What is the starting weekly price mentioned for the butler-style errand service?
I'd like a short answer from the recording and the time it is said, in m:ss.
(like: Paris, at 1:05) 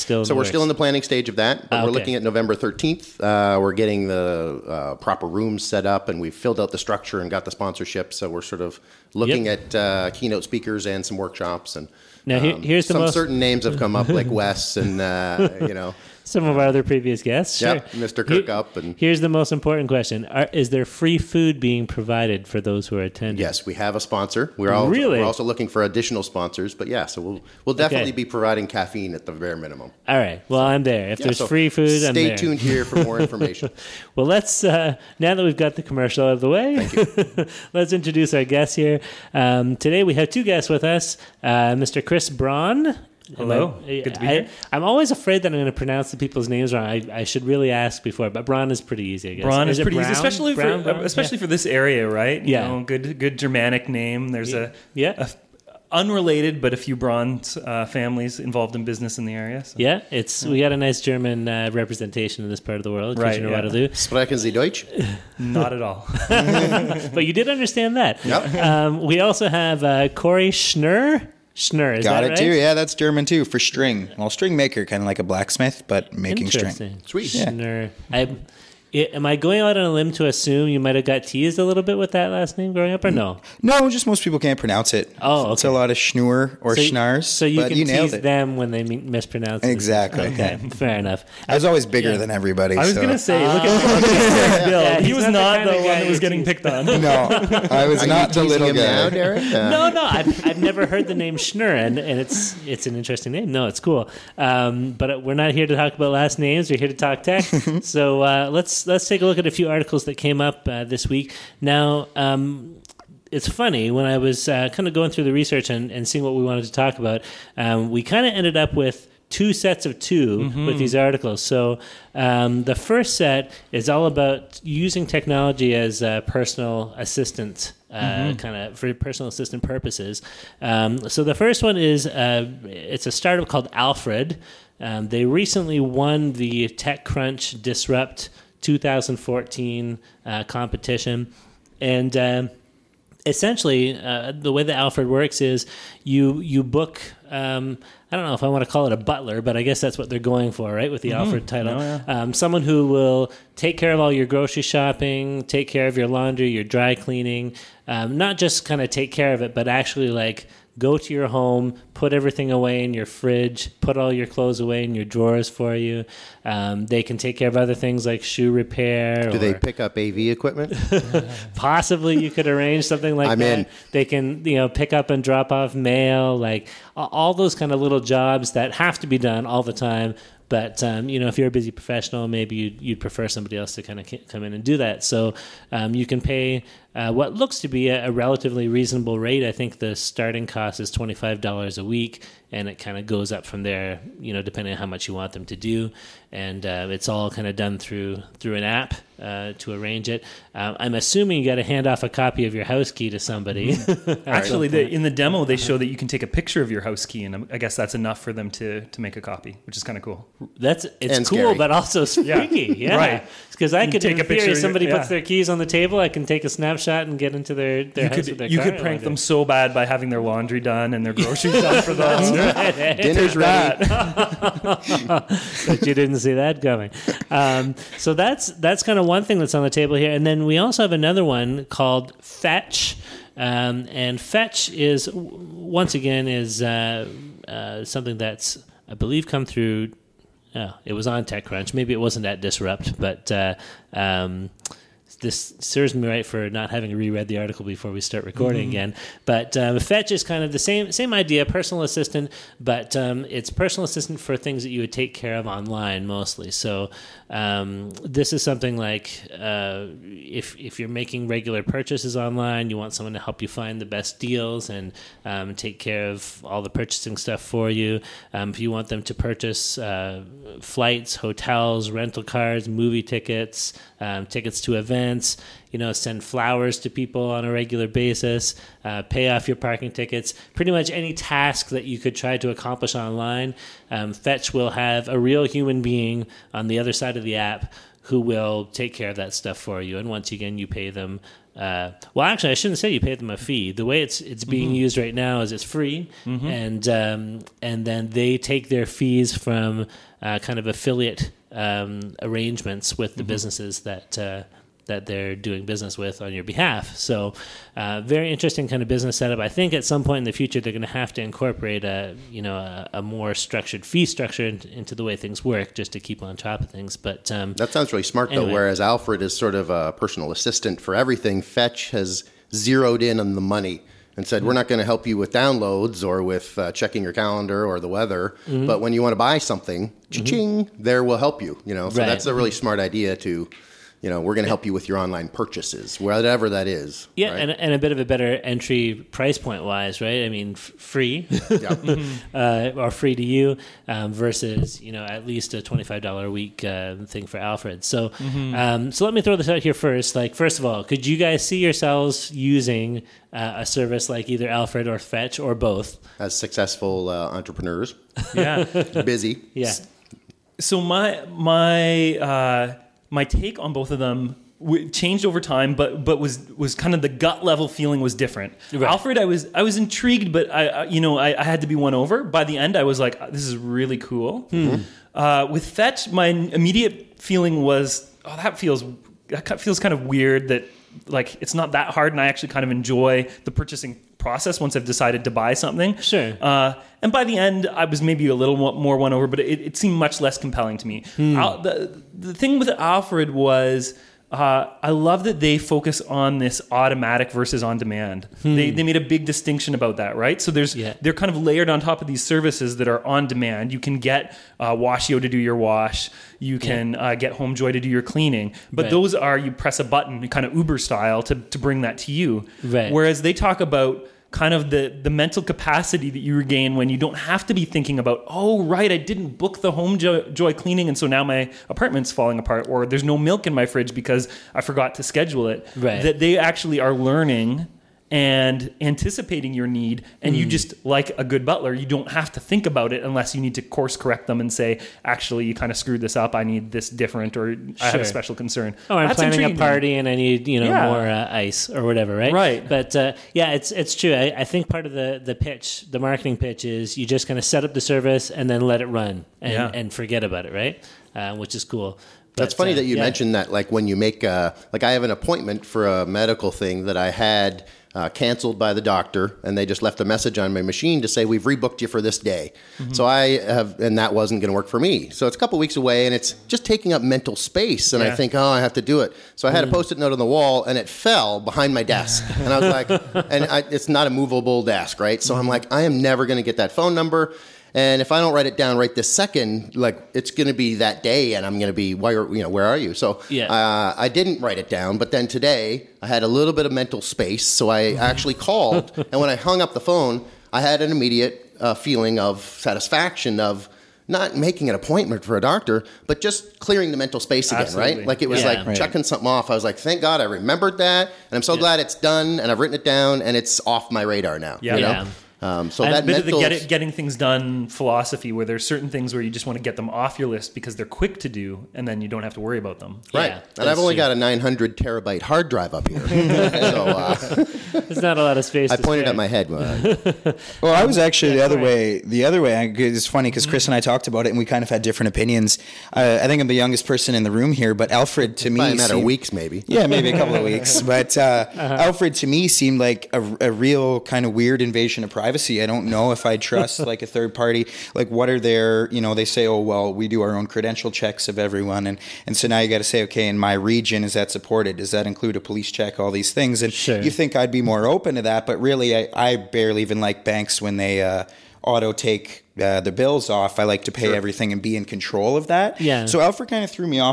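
$25, at 3:10.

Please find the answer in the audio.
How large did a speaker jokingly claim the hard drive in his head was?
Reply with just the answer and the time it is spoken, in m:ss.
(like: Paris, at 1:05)
900 terabytes, at 8:34.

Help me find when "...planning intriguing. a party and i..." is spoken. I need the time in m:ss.
7:19.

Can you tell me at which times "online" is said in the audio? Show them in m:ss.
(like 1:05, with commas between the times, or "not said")
4:15, 4:22, 4:42, 5:34.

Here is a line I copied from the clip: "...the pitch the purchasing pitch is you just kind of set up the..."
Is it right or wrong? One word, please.
wrong.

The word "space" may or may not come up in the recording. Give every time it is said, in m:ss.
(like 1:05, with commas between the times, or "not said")
7:47, 8:07, 8:17, 8:38.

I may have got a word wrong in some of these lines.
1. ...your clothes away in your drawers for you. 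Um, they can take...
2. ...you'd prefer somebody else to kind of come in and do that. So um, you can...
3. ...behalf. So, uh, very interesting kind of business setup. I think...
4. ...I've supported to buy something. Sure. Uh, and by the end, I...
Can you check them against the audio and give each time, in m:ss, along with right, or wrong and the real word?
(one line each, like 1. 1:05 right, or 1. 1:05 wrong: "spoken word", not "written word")
1. 2:44 right
2. 3:02 right
3. 5:06 right
4. 6:24 wrong: "decided", not "supported".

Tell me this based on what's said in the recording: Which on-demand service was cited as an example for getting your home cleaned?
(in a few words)
HomeJoy.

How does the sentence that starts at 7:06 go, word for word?
that they actually are learning and anticipating your need and mm.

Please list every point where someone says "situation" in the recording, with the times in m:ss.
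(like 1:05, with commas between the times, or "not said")
not said.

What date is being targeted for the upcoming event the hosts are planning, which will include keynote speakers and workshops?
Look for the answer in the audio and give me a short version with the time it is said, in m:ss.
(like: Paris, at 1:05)
November 13, at 0:02.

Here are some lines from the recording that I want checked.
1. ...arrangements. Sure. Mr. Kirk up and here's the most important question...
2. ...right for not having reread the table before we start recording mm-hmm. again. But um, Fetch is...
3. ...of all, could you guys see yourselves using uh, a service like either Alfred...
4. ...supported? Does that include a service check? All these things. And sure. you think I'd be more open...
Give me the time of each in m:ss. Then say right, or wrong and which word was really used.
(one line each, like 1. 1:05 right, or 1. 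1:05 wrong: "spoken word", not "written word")
1. 0:17 wrong: "guests", not "arrangements"
2. 4:06 wrong: "article", not "table"
3. 5:50 right
4. 9:04 wrong: "police", not "service".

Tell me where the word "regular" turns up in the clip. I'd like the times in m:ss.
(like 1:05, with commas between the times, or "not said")
4:21, 4:37.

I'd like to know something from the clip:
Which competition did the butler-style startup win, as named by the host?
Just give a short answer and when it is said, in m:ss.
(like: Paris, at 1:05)
TechCrunch Disrupt 2014, at 2:16.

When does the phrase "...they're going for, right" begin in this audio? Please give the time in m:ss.
2:30.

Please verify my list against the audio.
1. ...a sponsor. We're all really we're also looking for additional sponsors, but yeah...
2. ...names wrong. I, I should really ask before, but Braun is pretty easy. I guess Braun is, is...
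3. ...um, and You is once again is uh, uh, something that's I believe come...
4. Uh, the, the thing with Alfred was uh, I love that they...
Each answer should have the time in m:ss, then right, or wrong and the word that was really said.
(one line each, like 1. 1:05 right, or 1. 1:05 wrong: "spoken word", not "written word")
1. 0:23 right
2. 0:46 right
3. 3:53 wrong: "Fetch", not "You"
4. 6:31 right.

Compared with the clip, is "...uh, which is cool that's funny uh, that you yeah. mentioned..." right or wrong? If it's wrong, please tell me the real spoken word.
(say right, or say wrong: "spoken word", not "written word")
right.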